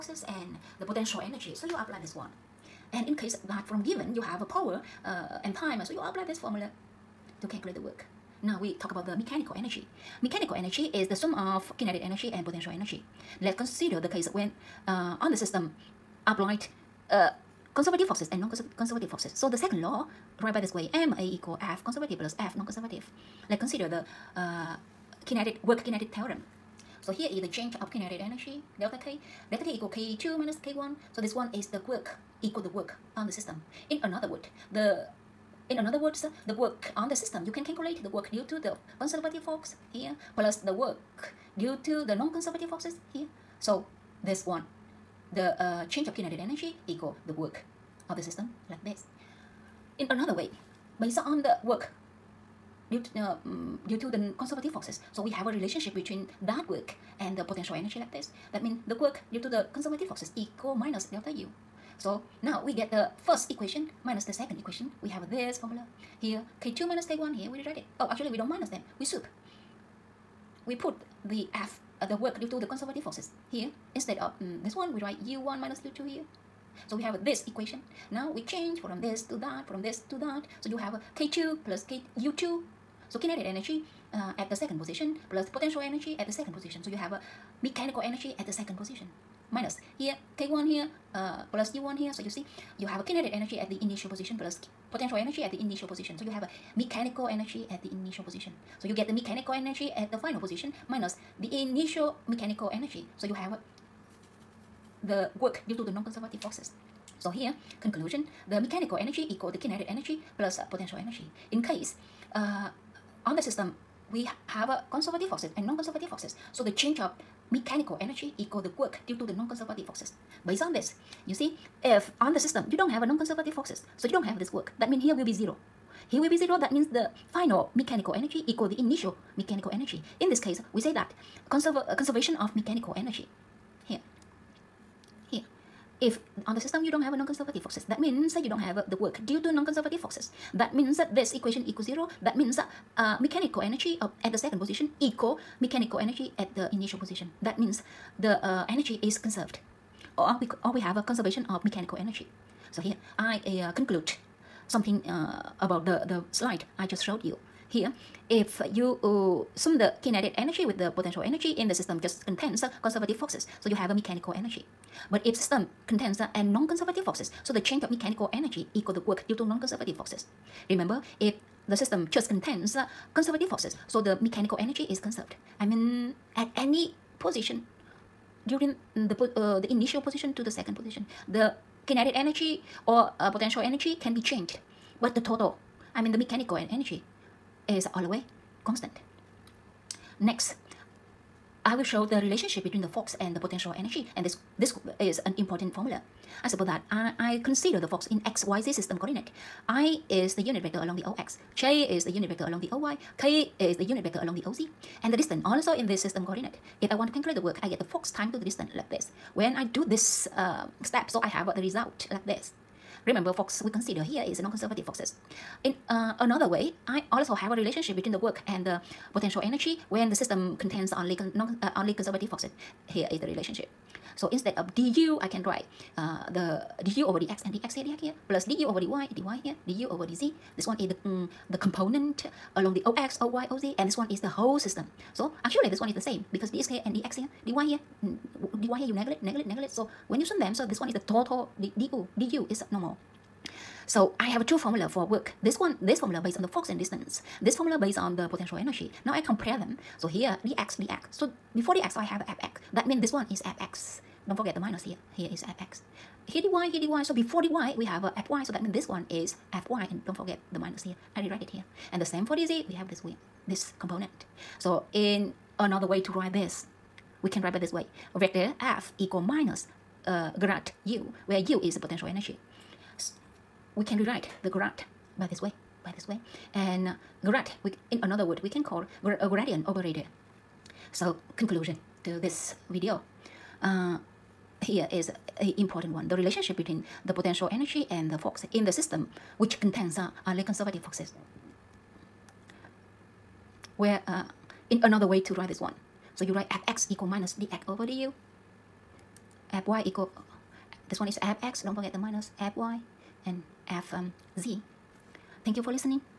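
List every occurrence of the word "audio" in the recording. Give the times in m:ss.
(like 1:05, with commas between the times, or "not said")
not said.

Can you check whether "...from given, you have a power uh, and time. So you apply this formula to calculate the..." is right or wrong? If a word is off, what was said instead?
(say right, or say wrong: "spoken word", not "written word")
right.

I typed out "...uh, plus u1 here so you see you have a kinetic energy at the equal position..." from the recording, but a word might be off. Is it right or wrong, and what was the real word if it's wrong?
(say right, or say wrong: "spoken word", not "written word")
wrong: "initial", not "equal".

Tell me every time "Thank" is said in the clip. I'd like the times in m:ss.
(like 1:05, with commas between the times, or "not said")
5:05.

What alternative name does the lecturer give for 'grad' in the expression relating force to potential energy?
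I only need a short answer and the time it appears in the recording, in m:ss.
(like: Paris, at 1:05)
Gradient operator, at 4:39.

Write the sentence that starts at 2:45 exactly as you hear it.
But if system contains and non-conservative forces, so the change of mechanical energy equals the work due to non-conservative forces.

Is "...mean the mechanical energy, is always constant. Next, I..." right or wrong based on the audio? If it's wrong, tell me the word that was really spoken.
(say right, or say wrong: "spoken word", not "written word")
right.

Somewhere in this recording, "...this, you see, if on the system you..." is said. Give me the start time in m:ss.
2:00.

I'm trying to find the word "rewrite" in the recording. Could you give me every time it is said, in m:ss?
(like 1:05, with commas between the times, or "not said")
1:07, 4:21, 4:33.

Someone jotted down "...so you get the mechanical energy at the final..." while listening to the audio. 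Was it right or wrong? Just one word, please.
right.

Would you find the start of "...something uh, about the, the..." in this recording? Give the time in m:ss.
2:34.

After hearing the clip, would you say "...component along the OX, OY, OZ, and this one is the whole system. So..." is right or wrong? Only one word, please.
right.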